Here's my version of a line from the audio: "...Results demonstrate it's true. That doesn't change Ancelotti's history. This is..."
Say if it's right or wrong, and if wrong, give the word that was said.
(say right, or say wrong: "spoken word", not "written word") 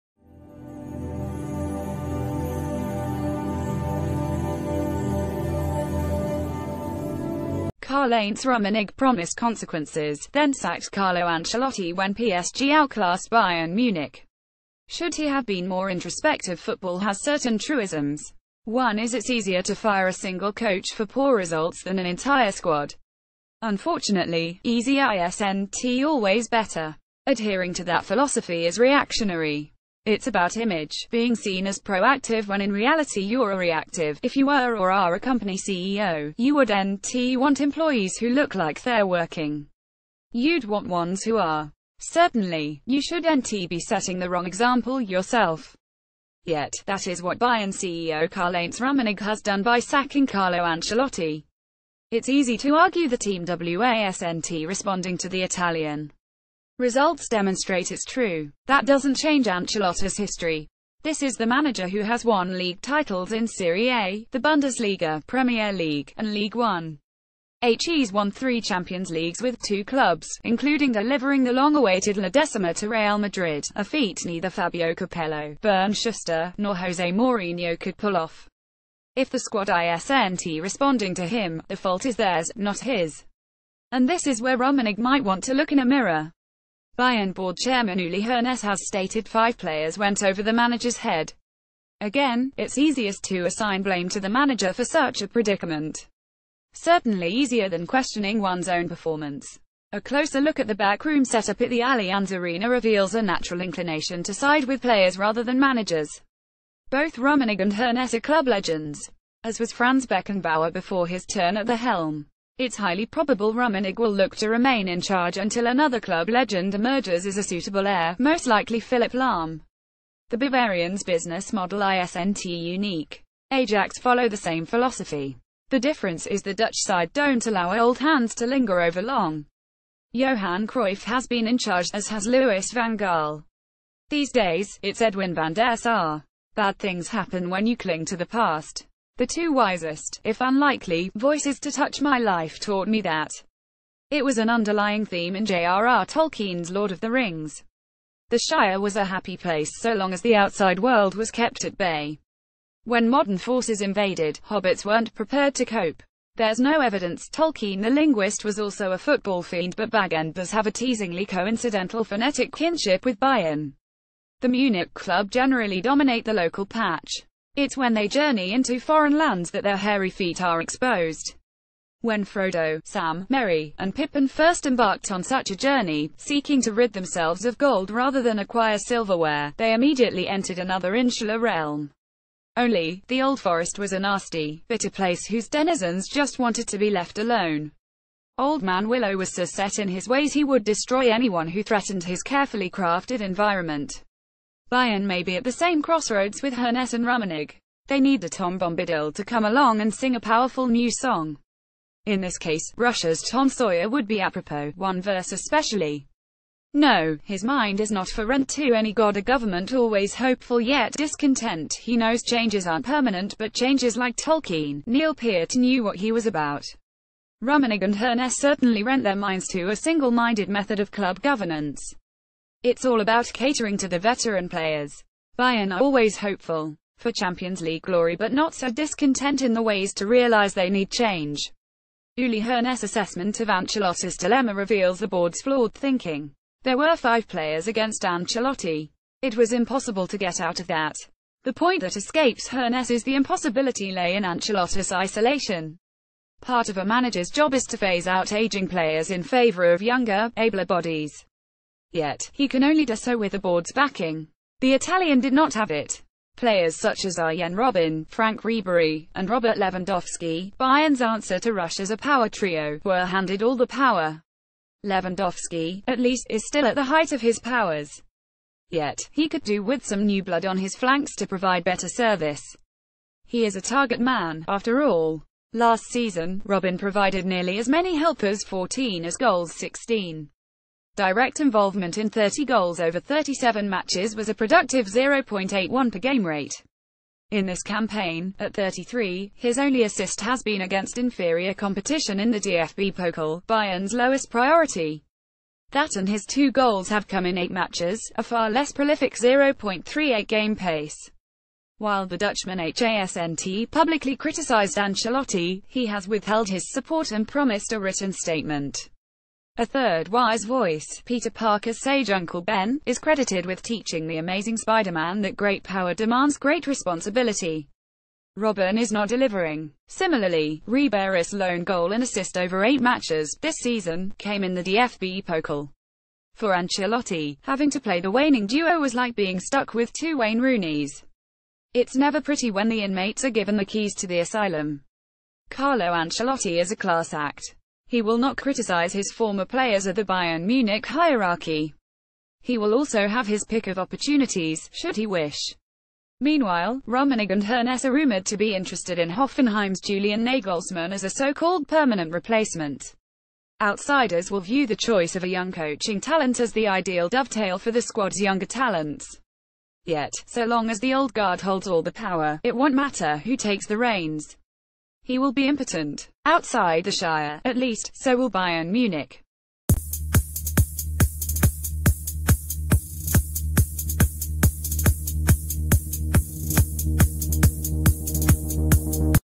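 right.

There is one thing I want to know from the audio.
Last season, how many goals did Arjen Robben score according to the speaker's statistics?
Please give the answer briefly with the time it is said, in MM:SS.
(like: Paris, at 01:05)
16, at 04:39.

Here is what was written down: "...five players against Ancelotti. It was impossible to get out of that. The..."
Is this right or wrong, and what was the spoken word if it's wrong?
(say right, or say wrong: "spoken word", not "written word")
right.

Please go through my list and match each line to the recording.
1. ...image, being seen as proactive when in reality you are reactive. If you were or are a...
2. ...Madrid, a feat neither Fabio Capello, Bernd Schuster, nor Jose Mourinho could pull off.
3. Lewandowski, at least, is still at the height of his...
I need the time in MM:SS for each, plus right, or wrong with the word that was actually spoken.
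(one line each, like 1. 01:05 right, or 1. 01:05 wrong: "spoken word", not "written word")
1. 00:30 right
2. 01:13 right
3. 04:24 right.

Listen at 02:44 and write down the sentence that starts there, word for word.
The Munich club generally dominate the local patch.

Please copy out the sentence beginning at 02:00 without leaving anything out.
The Bavarians' business model isn't unique.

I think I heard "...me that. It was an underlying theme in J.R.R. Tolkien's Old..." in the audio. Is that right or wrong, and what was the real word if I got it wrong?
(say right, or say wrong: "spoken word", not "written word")
wrong: "Lord", not "Old".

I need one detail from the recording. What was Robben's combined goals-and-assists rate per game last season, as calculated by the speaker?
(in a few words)
0.81.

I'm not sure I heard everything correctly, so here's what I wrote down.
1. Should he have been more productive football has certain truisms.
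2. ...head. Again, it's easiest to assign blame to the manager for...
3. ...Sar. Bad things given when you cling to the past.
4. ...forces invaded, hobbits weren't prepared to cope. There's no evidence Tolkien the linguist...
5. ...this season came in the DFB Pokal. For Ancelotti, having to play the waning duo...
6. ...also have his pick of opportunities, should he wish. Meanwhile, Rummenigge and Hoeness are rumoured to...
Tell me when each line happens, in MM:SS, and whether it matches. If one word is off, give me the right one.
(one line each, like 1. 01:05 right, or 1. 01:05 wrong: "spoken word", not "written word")
1. 00:14 wrong: "introspective", not "productive"
2. 01:30 right
3. 02:15 wrong: "happen", not "given"
4. 02:33 right
5. 05:23 right
6. 05:42 right.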